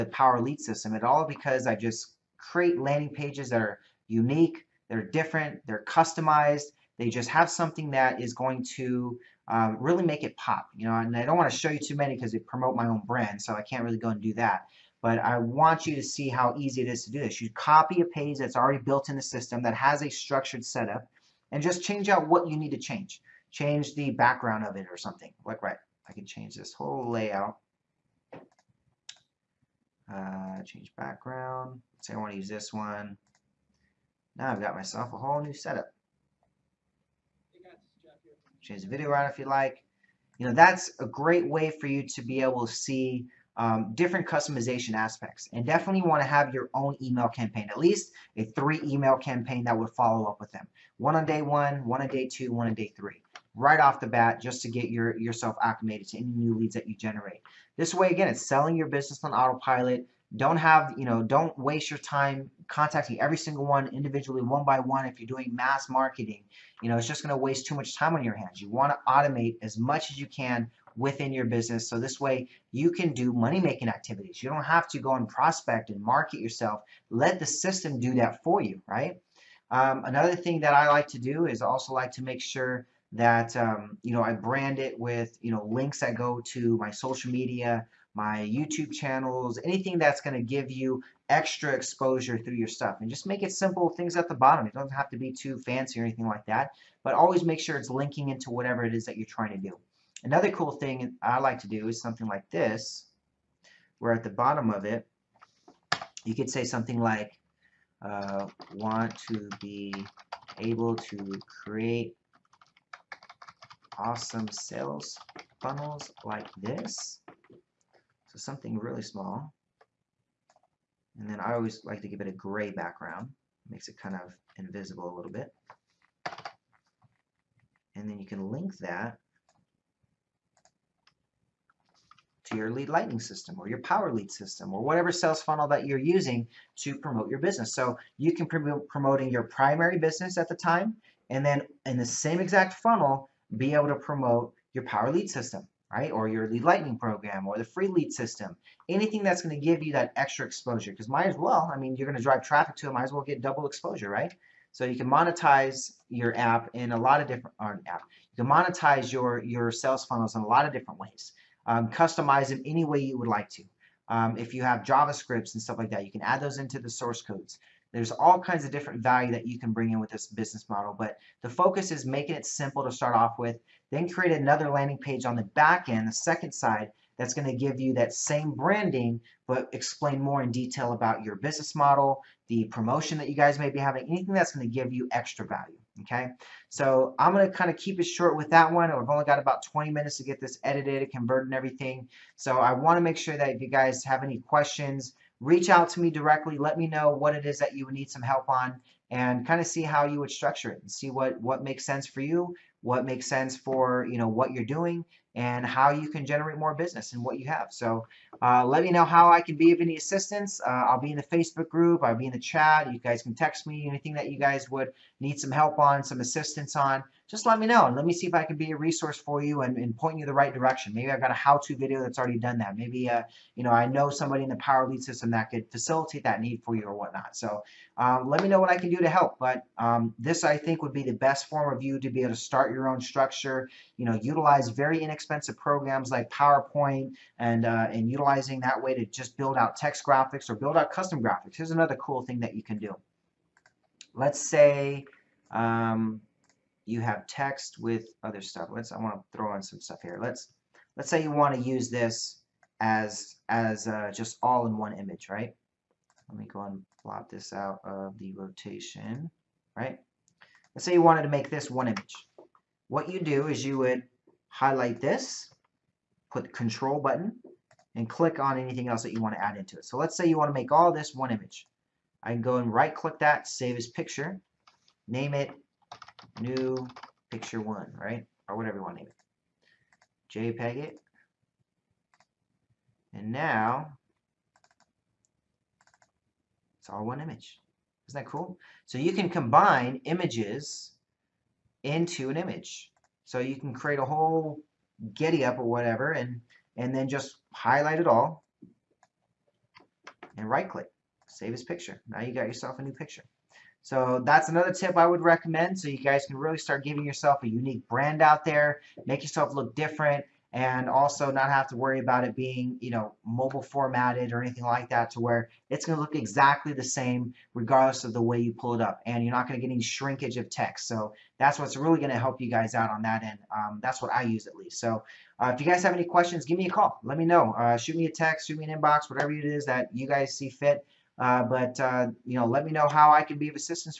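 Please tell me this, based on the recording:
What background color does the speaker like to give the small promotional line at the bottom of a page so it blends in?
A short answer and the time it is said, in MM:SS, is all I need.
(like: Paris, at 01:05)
Gray, at 02:02.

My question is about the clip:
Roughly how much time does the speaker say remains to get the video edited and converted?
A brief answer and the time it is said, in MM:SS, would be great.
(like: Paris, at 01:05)
20 minutes, at 03:09.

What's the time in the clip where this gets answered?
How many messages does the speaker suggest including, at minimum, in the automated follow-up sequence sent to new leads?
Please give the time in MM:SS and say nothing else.
00:48.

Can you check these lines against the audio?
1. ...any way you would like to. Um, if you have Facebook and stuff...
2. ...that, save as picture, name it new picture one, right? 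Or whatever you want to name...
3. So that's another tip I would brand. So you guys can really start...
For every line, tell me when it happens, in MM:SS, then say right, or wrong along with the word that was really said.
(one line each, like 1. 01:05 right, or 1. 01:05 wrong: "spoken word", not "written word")
1. 02:42 wrong: "JavaScripts", not "Facebook"
2. 04:33 right
3. 05:03 wrong: "recommend", not "brand".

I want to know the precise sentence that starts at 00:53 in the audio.
Right off the bat, just to get your yourself acclimated to any new leads that you generate.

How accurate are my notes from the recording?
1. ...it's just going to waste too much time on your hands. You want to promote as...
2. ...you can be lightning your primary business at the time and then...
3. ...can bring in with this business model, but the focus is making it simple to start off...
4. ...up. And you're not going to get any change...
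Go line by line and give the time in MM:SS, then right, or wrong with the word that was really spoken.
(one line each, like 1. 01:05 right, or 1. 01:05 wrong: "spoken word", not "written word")
1. 01:06 wrong: "automate", not "promote"
2. 02:18 wrong: "promoting", not "lightning"
3. 02:49 right
4. 05:18 wrong: "shrinkage", not "change".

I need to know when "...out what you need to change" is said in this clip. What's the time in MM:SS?
00:22.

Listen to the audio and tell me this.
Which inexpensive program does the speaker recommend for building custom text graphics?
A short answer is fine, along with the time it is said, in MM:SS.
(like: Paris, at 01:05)
PowerPoint, at 03:56.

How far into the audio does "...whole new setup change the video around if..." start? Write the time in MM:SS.
00:35.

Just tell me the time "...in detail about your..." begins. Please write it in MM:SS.
03:00.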